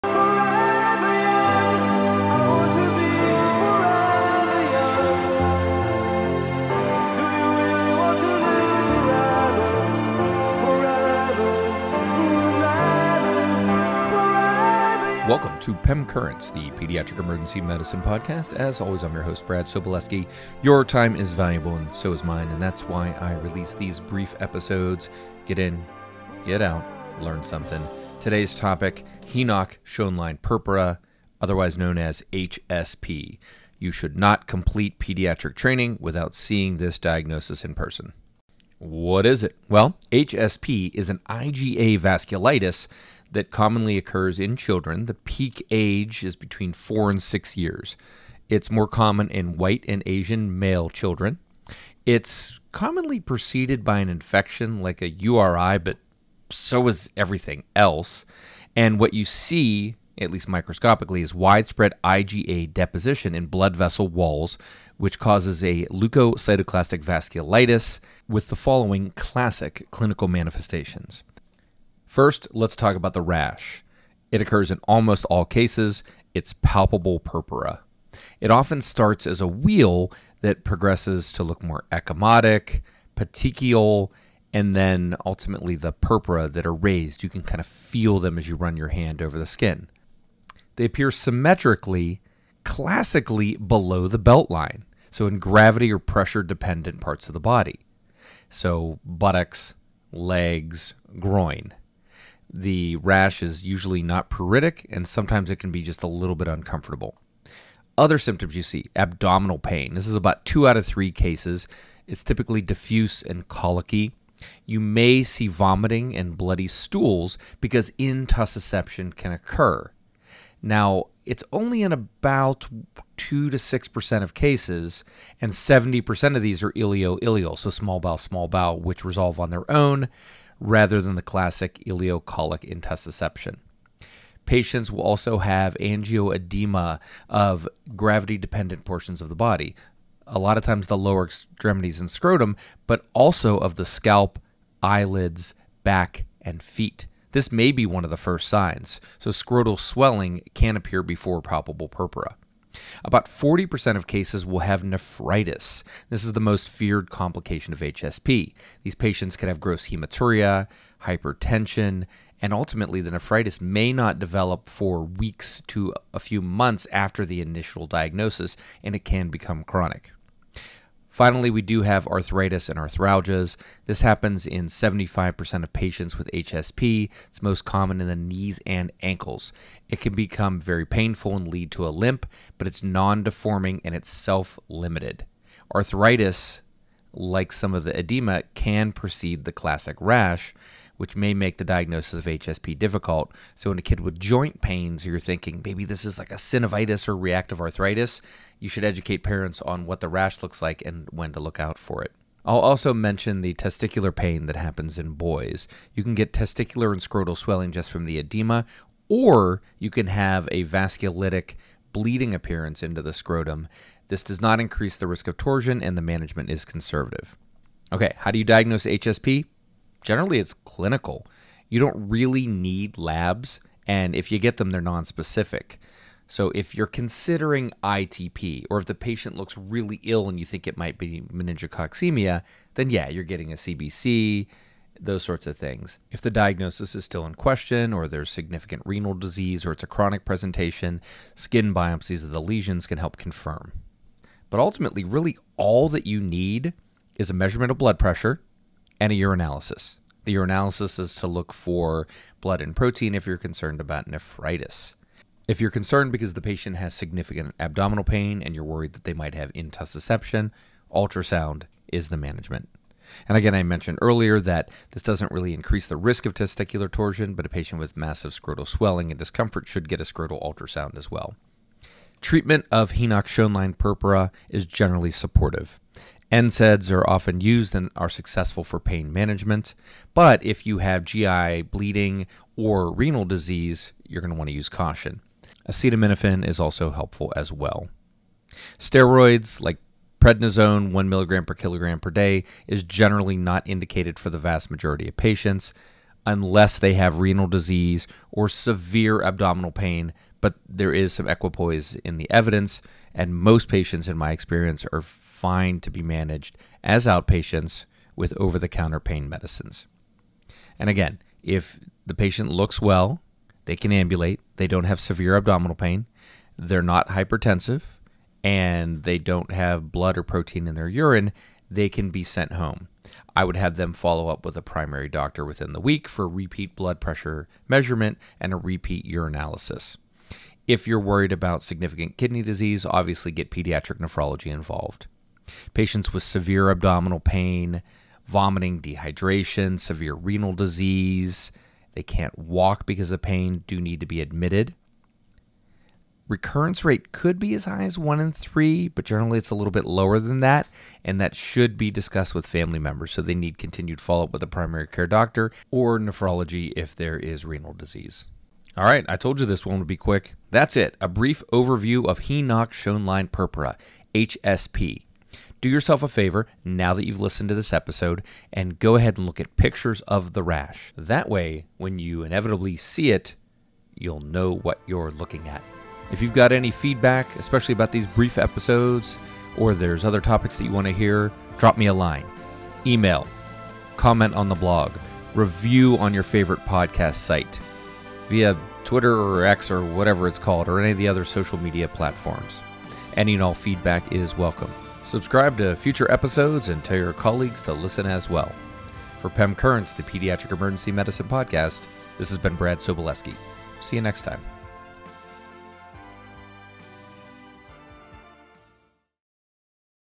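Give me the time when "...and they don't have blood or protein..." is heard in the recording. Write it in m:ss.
5:18.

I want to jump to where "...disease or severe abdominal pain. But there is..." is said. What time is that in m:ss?
4:57.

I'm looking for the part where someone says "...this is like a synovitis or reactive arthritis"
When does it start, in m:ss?
3:15.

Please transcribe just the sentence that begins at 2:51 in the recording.
Finally, we do have arthritis and arthralgias.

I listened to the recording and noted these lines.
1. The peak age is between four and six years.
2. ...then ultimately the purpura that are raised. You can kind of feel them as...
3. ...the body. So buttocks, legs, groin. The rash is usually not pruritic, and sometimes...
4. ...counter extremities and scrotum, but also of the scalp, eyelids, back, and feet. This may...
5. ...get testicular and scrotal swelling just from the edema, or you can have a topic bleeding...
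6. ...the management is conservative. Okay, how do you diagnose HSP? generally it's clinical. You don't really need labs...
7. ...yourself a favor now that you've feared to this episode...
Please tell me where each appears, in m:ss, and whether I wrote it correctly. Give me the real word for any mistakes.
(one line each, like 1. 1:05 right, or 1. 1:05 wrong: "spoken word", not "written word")
1. 0:45 right
2. 1:24 right
3. 1:37 right
4. 2:20 wrong: "lower", not "counter"
5. 3:26 wrong: "vasculitic", not "topic"
6. 3:35 right
7. 6:05 wrong: "listened", not "feared".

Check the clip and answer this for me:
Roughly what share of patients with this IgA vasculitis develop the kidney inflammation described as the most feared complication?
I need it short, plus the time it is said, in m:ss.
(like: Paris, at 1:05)
40%, at 2:33.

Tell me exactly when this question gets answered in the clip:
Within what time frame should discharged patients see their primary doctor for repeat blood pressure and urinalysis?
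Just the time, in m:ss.
5:25.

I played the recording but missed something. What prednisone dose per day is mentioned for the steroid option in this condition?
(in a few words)
1 mg/kg/day.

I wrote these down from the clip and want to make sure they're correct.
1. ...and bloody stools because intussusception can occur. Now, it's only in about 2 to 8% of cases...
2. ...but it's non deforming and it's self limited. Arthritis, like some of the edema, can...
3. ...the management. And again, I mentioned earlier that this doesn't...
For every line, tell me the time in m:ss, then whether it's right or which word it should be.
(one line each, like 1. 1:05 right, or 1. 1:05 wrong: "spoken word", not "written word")
1. 1:56 wrong: "6", not "8"
2. 3:02 right
3. 4:22 right.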